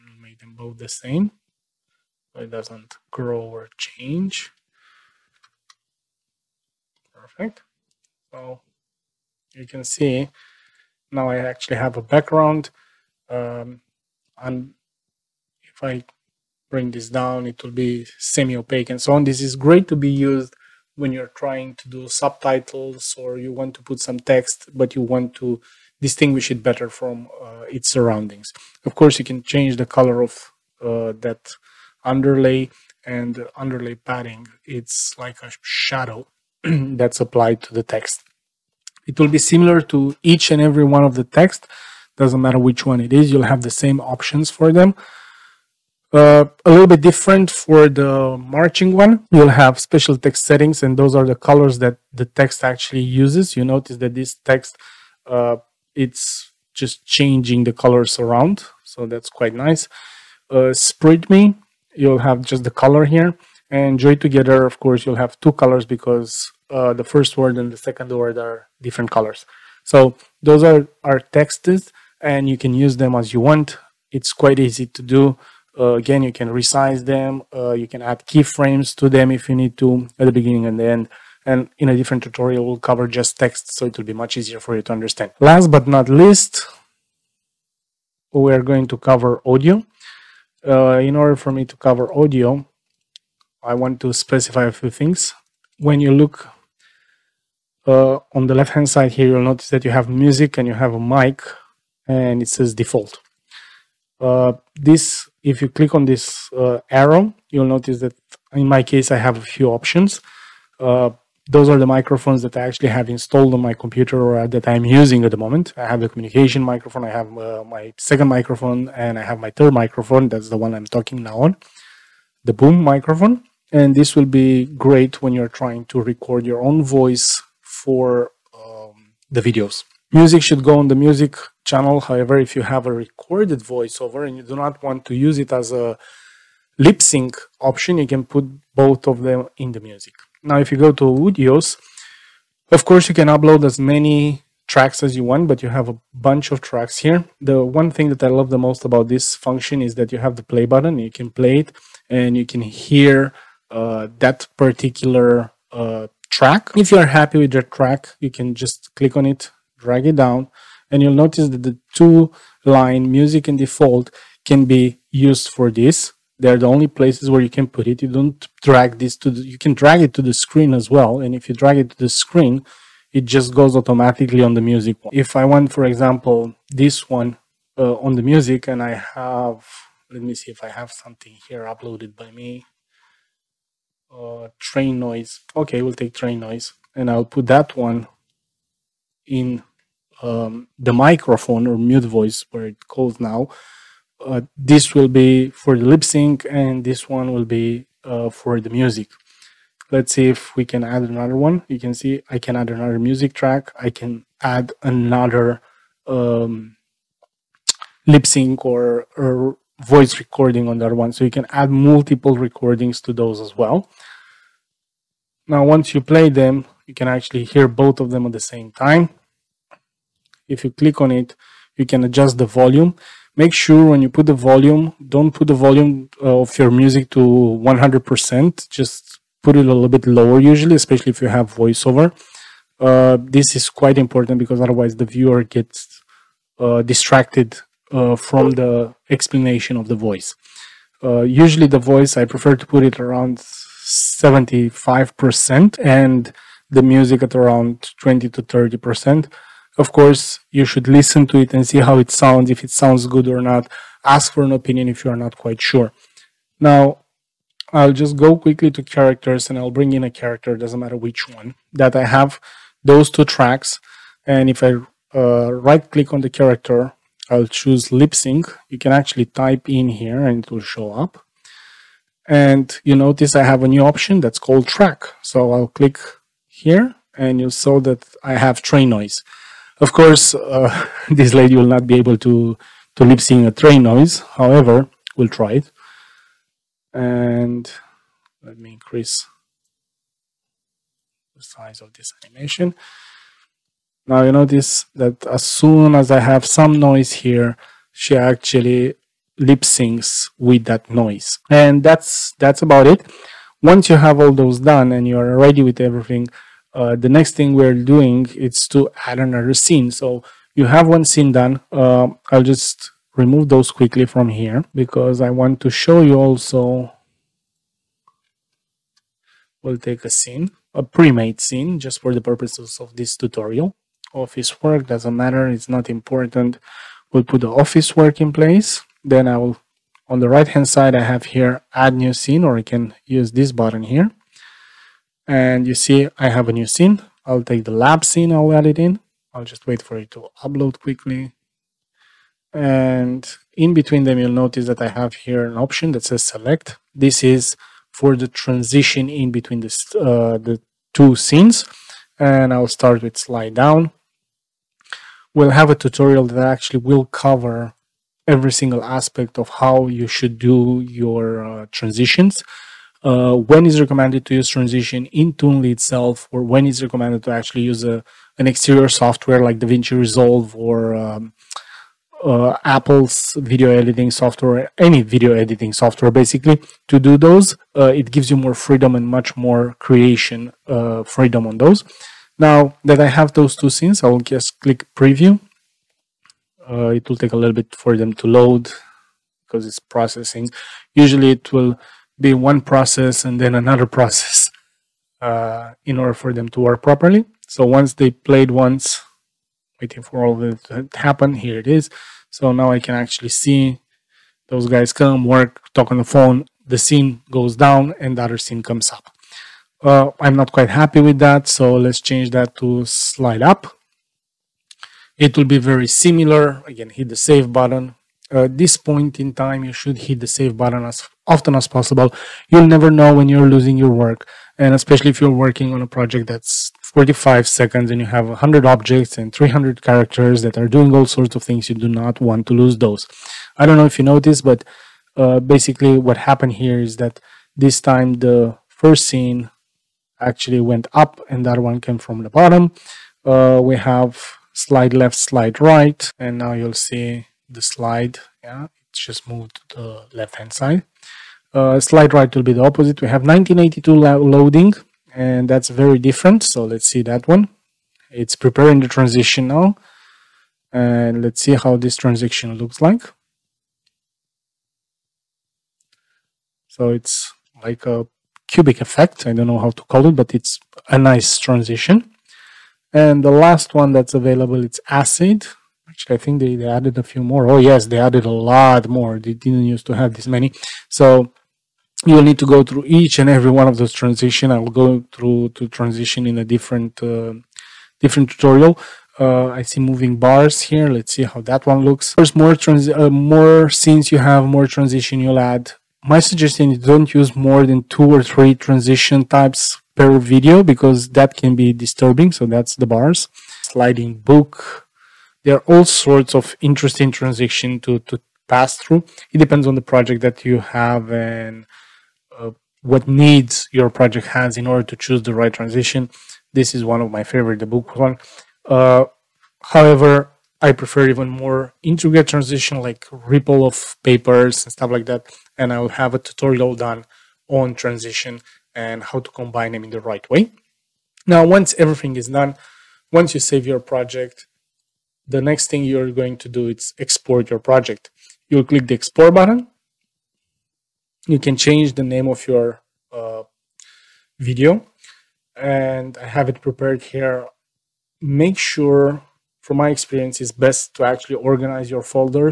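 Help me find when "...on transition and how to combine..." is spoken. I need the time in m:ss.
8:47.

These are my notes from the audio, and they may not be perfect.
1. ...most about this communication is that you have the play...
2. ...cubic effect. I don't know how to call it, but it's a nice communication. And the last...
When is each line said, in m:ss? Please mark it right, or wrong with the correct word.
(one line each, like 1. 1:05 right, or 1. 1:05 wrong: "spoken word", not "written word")
1. 2:28 wrong: "function", not "communication"
2. 7:48 wrong: "transition", not "communication".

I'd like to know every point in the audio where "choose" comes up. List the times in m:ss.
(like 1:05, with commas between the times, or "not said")
4:27, 8:34.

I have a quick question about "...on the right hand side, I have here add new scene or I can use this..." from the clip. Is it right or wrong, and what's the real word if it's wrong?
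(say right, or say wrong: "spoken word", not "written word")
right.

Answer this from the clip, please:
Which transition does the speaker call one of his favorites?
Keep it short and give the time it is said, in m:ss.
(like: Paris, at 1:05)
the book one, at 8:37.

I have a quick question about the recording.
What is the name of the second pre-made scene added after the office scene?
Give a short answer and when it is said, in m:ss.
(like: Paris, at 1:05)
lab scene, at 5:37.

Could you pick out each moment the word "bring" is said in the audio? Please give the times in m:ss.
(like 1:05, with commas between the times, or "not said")
0:16, 4:19.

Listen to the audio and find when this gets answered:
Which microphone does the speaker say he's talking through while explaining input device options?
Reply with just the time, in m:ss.
2:02.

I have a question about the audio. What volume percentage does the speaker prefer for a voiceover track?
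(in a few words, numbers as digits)
75%.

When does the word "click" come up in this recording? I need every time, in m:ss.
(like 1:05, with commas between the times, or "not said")
1:45, 2:38, 3:40, 4:25, 4:35, 6:24, 8:58.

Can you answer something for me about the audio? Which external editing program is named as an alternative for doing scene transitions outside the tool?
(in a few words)
DaVinci Resolve.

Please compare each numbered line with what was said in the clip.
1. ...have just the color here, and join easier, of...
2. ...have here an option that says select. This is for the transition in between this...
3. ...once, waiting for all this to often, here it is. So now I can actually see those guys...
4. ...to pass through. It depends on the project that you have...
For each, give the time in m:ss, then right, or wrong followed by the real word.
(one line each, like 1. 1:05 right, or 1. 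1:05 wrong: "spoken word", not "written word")
1. 1:02 wrong: "together", not "easier"
2. 5:44 right
3. 6:38 wrong: "happen", not "often"
4. 8:27 right.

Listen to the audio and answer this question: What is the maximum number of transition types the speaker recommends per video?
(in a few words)
3.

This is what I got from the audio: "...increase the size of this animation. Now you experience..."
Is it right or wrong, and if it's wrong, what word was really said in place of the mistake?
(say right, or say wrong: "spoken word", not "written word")
wrong: "notice", not "experience".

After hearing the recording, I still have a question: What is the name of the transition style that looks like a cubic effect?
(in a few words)
1982 loading.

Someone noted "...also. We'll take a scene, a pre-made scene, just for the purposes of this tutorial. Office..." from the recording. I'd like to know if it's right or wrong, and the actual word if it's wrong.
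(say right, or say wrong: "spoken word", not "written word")
right.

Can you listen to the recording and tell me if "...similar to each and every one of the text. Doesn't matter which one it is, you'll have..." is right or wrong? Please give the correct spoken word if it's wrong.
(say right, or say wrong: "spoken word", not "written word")
right.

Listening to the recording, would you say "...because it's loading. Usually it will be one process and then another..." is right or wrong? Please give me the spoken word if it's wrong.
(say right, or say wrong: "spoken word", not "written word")
wrong: "processing", not "loading".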